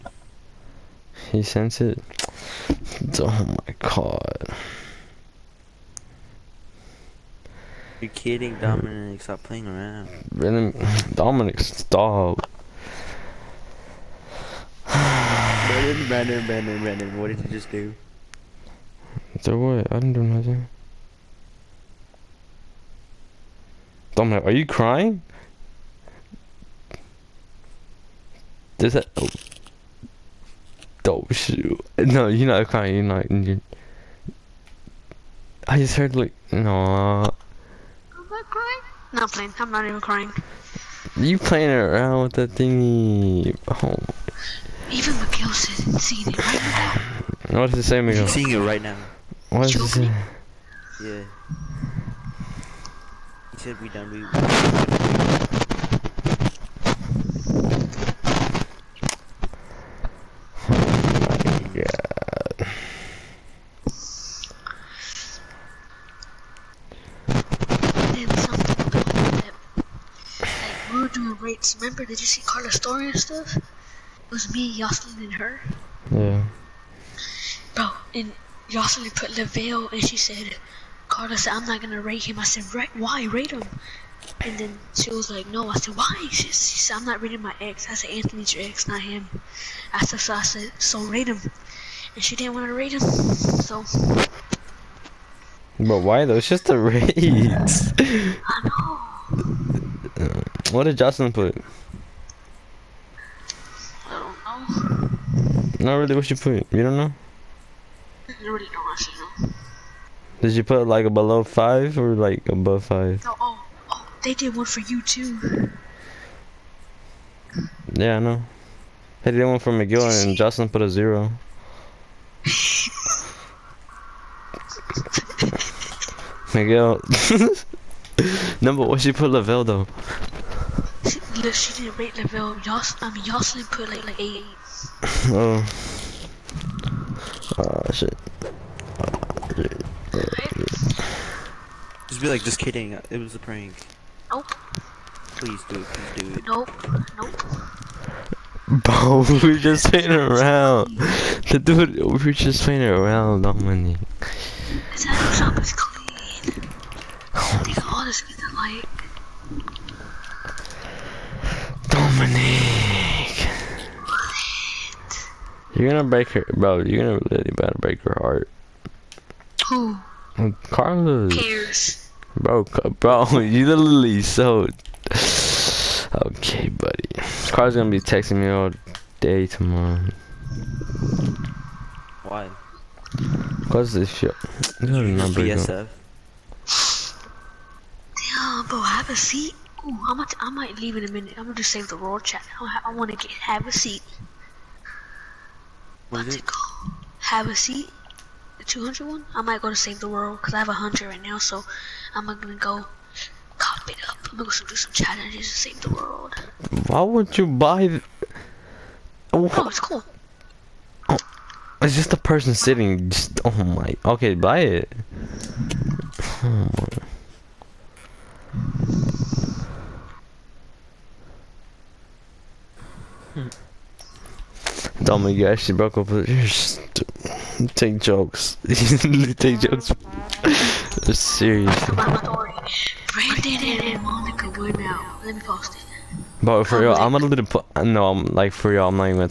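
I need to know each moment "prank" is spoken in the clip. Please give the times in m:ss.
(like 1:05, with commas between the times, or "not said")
2:23.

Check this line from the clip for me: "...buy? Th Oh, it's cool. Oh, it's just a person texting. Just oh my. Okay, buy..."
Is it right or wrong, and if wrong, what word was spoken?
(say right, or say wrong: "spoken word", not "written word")
wrong: "sitting", not "texting".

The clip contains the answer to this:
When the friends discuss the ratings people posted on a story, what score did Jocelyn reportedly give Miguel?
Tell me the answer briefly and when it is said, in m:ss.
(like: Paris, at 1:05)
0, at 2:00.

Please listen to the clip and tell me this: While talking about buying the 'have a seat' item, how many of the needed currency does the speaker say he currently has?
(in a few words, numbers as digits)
100.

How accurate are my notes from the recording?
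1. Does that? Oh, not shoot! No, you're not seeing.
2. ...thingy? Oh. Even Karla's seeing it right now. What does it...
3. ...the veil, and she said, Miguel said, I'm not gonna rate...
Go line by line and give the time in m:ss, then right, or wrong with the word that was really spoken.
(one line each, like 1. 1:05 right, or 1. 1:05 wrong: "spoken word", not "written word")
1. 0:28 wrong: "crying", not "seeing"
2. 0:42 wrong: "Miguel", not "Karla"
3. 1:19 wrong: "Carla", not "Miguel".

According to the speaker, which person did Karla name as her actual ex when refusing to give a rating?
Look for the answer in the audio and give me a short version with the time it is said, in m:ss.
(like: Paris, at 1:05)
Anthony, at 1:28.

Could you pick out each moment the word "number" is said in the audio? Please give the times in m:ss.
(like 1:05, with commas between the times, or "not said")
2:08, 3:05.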